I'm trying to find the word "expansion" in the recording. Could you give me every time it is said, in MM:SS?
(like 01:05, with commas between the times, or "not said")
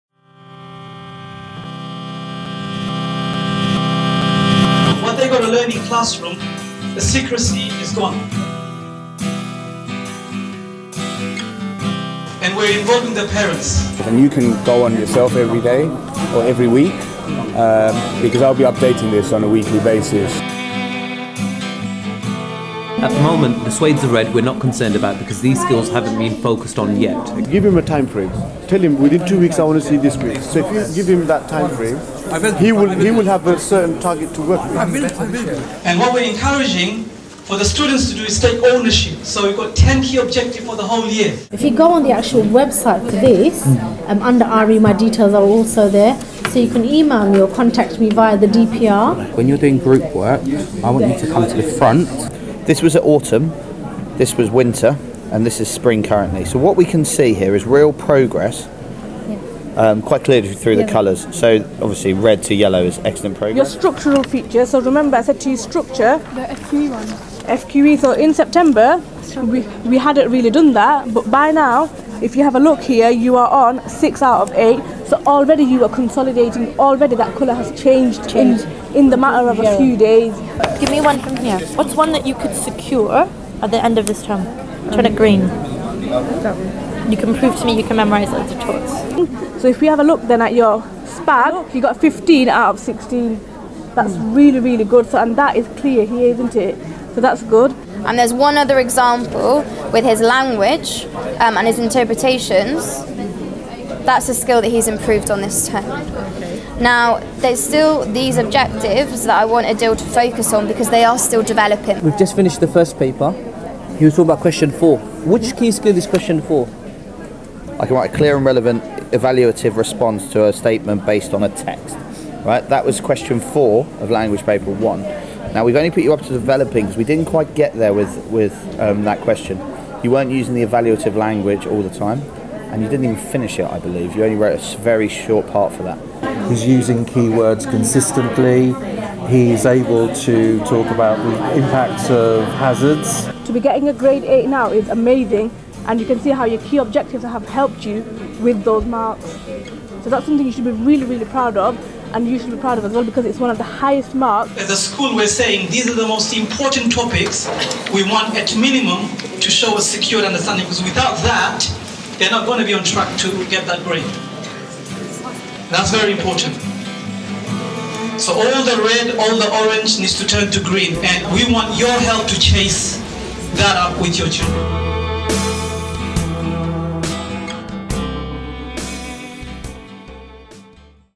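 not said.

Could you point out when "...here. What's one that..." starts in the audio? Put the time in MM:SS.
01:21.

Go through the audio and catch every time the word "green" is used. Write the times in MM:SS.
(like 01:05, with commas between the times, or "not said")
01:25, 02:50.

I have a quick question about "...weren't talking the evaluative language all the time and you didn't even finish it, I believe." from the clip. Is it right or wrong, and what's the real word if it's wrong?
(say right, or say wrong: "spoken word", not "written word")
wrong: "using", not "talking".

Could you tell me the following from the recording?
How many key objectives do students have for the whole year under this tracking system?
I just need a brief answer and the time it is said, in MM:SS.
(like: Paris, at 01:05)
10, at 00:39.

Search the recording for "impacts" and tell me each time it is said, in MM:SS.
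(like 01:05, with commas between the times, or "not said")
02:21.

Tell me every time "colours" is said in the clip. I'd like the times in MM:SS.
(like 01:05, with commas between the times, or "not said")
01:00, 01:17.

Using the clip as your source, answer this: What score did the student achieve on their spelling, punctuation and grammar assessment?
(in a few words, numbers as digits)
15 out of 16.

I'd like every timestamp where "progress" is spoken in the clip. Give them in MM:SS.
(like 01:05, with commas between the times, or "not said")
00:57, 01:03.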